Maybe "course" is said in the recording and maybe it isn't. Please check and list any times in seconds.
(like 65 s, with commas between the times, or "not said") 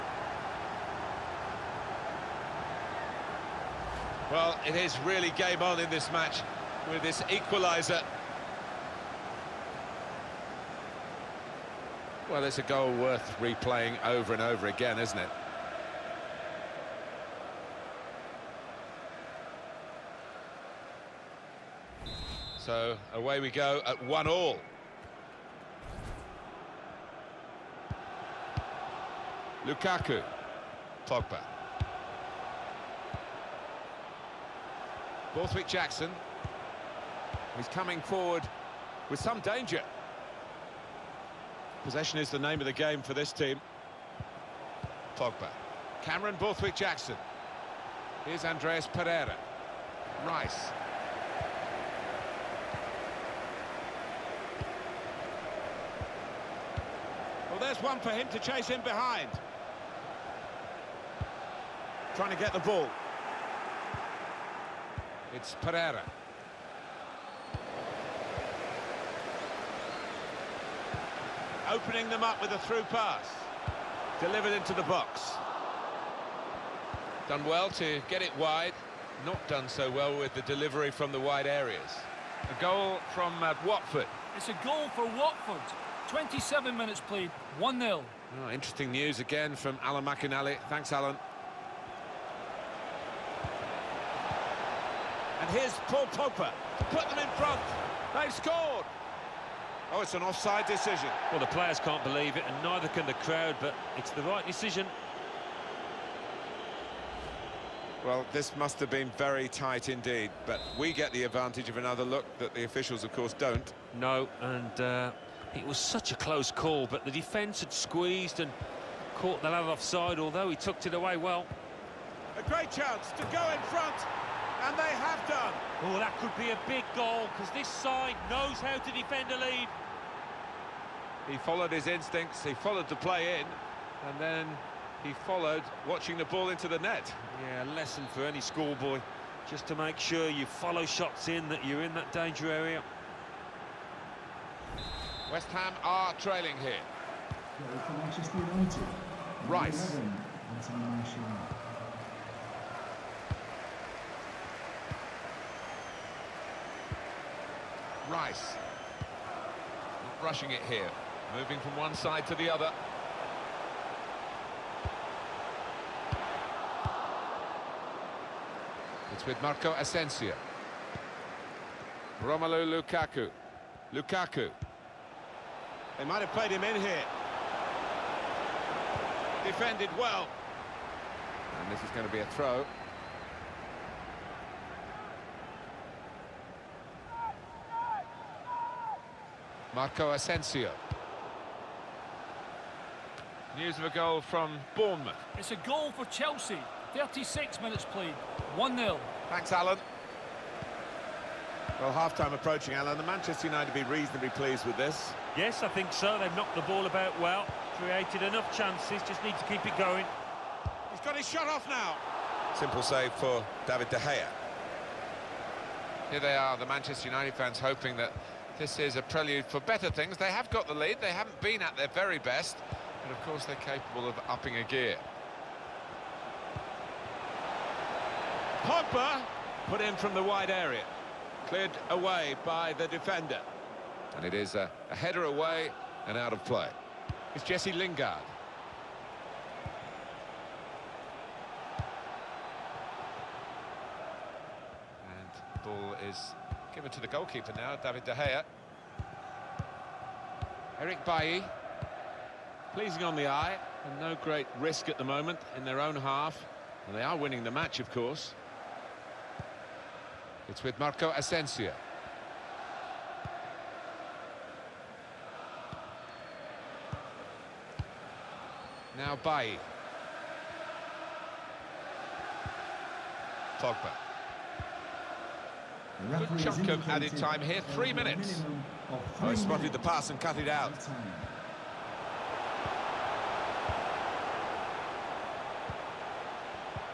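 113 s, 223 s, 257 s.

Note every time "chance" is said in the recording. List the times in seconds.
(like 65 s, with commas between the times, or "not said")
122 s, 208 s.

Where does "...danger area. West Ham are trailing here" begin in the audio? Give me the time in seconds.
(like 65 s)
142 s.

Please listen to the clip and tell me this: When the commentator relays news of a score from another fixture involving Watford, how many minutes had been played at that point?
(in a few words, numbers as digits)
27.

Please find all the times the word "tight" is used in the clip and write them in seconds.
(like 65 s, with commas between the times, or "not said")
109 s.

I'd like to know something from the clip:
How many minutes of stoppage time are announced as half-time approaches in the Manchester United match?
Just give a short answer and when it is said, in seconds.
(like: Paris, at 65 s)
3, at 277 s.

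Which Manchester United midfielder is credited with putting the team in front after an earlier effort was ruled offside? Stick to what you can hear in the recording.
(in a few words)
Paul Pogba.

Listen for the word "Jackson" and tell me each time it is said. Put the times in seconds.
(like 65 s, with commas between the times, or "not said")
35 s, 46 s.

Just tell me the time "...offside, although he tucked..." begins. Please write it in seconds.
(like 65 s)
119 s.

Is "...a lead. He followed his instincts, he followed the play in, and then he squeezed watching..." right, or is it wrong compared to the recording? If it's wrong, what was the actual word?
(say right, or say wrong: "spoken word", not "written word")
wrong: "followed", not "squeezed".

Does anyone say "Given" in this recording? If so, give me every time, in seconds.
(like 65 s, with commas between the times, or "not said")
246 s.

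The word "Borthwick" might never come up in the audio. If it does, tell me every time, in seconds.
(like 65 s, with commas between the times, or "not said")
35 s, 46 s.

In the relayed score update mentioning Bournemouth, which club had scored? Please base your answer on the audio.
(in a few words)
Chelsea.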